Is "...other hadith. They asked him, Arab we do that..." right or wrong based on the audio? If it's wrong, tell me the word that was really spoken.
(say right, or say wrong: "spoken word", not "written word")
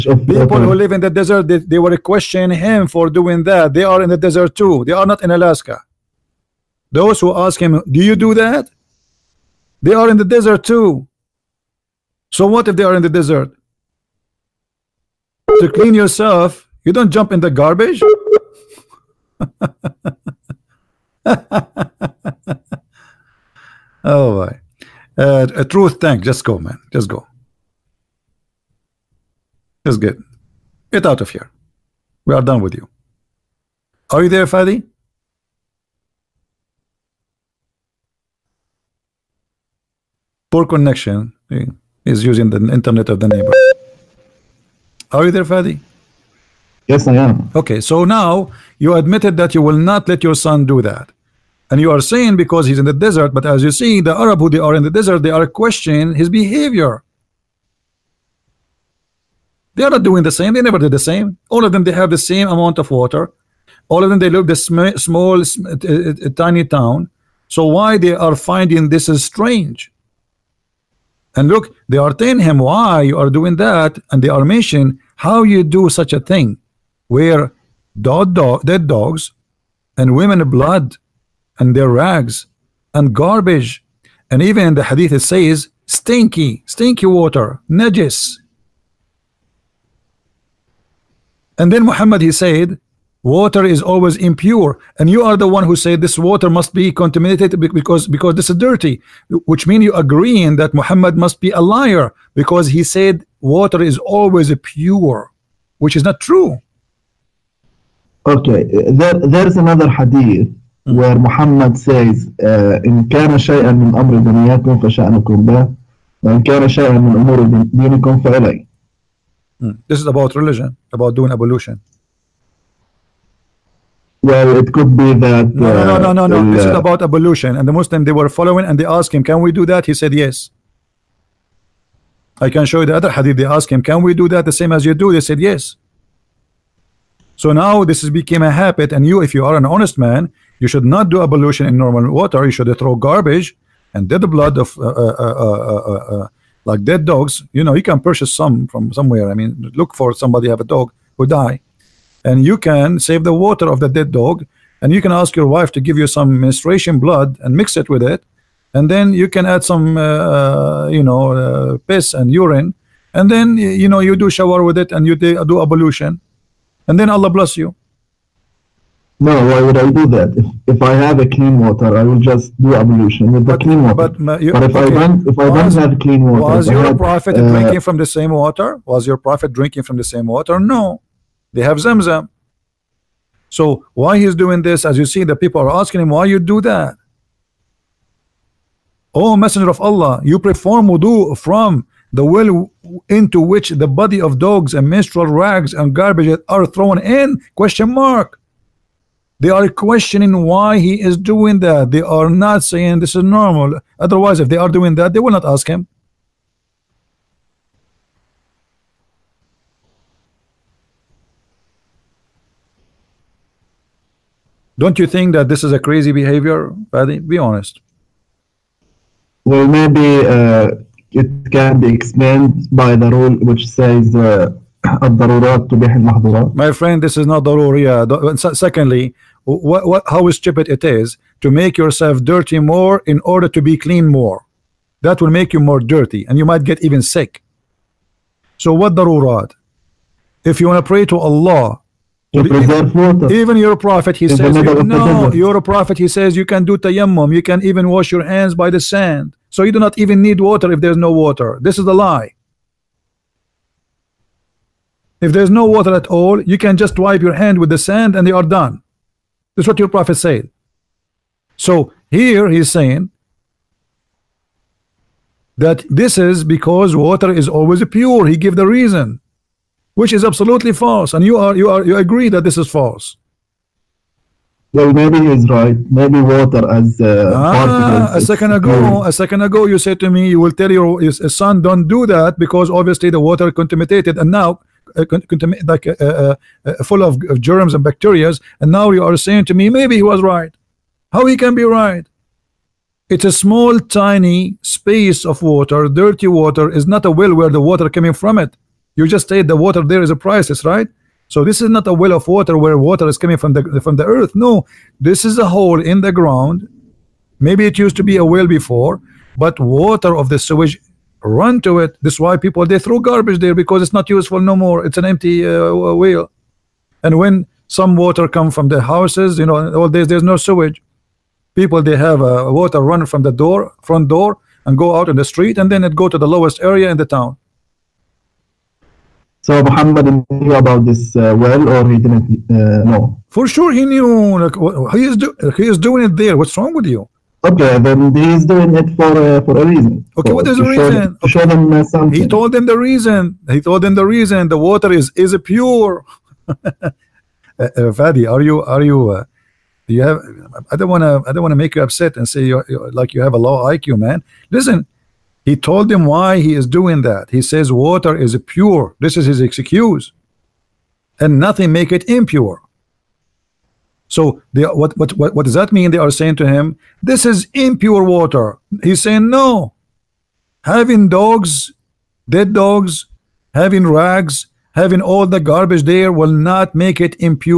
wrong: "Can", not "Arab".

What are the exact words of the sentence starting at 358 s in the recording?
This is his excuse, and nothing make it impure.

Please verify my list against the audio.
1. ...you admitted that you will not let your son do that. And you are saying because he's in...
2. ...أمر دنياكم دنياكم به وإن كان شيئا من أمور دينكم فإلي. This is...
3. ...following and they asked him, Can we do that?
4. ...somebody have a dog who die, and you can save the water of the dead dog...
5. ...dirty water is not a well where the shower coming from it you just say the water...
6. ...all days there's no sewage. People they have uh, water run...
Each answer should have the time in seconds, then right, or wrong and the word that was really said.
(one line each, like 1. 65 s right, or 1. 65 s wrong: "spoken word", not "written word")
1. 48 s right
2. 113 s wrong: "فشأنكم", not "دنياكم"
3. 128 s right
4. 150 s right
5. 295 s wrong: "water", not "shower"
6. 319 s right.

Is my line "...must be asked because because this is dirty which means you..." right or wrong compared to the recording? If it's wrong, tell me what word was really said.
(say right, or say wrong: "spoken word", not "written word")
wrong: "contaminated", not "asked".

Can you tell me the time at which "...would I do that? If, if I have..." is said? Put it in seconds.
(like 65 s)
169 s.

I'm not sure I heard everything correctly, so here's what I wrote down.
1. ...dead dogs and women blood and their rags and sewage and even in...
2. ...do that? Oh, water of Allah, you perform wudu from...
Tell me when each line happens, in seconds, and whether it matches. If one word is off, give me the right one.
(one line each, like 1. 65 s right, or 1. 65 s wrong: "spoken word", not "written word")
1. 78 s wrong: "garbage", not "sewage"
2. 186 s wrong: "messenger", not "water".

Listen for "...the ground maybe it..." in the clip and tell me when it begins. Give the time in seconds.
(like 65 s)
306 s.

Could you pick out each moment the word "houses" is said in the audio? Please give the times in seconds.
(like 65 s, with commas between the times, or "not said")
318 s.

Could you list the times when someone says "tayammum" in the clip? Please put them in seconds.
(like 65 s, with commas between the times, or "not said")
246 s.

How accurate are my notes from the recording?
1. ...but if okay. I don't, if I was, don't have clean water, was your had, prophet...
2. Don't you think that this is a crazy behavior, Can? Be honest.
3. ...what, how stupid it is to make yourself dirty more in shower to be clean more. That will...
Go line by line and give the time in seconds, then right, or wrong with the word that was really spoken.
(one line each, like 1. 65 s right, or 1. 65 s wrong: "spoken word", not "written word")
1. 174 s right
2. 214 s wrong: "Fadi", not "Can"
3. 229 s wrong: "order", not "shower".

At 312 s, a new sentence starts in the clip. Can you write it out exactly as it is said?
That's why people they throw garbage there because it's not useful no more.